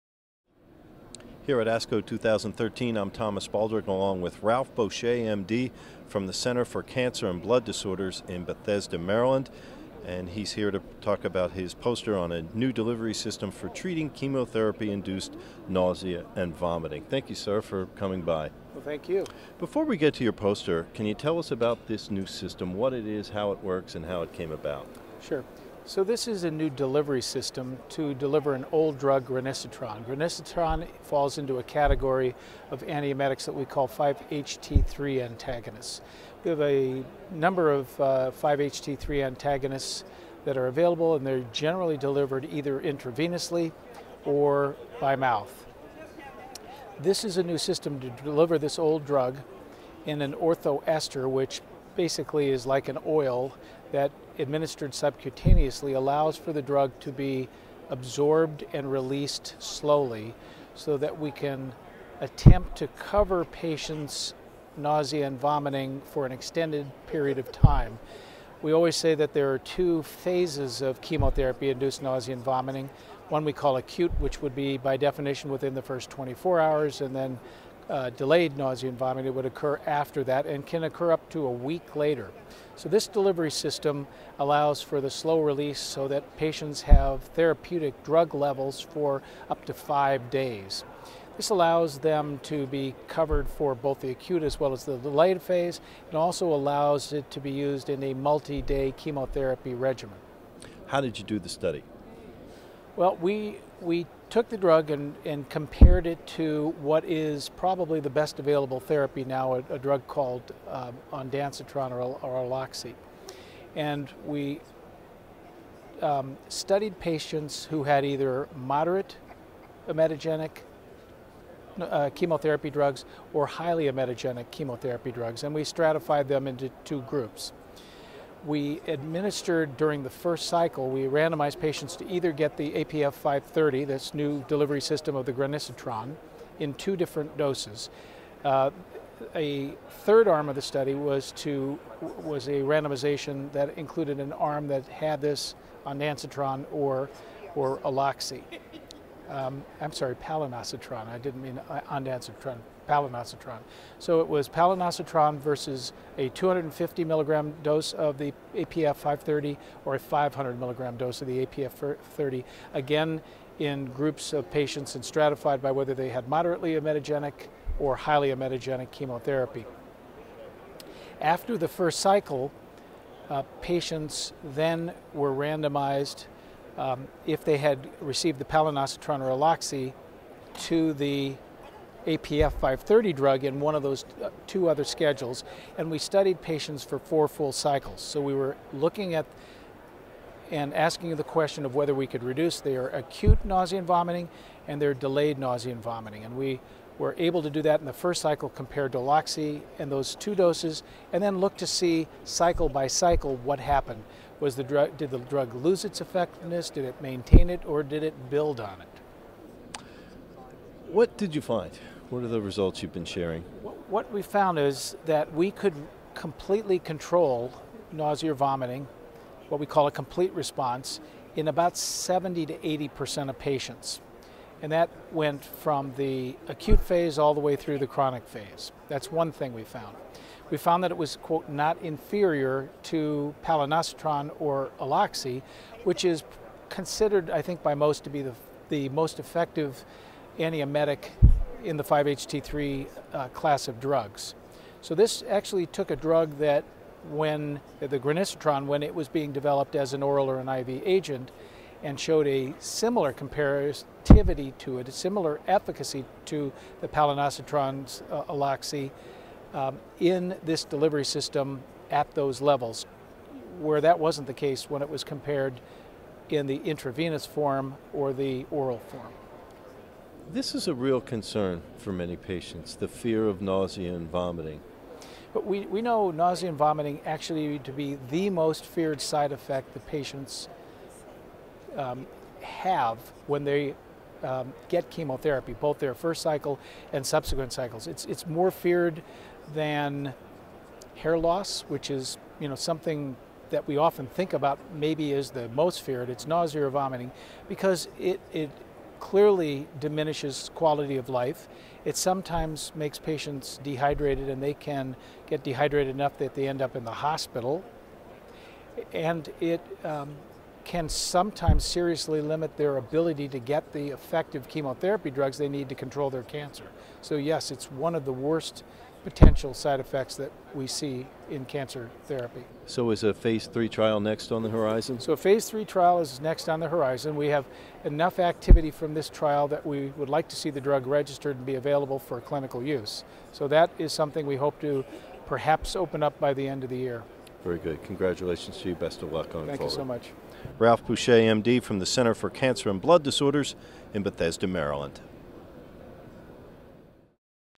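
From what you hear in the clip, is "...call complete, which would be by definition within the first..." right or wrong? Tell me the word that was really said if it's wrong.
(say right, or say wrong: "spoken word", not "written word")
wrong: "acute", not "complete".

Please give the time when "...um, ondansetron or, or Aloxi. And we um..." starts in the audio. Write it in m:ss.
1:50.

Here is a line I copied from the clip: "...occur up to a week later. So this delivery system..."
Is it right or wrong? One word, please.
right.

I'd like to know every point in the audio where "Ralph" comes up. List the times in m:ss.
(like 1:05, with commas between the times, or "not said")
0:04, 5:40.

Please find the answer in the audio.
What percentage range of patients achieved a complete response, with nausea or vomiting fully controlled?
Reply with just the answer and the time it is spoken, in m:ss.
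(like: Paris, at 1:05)
70 to 80%, at 3:41.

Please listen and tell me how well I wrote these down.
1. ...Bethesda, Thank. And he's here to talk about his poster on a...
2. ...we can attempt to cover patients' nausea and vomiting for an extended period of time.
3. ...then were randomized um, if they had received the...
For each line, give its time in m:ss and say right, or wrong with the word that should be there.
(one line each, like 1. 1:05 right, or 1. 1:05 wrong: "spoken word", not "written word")
1. 0:08 wrong: "Maryland", not "Thank"
2. 1:01 right
3. 2:54 right.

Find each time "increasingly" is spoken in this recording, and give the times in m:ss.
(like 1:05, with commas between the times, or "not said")
not said.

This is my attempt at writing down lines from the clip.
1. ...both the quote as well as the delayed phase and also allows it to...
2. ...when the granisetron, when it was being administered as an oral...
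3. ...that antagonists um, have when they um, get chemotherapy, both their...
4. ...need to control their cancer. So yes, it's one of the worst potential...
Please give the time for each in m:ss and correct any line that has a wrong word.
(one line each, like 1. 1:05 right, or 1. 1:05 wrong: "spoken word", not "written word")
1. 1:33 wrong: "acute", not "quote"
2. 4:07 wrong: "developed", not "administered"
3. 4:39 wrong: "patients", not "antagonists"
4. 5:15 right.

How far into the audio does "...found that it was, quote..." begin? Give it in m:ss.
3:50.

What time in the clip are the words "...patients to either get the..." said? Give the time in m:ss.
2:11.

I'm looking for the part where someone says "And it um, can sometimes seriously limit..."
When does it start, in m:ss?
5:08.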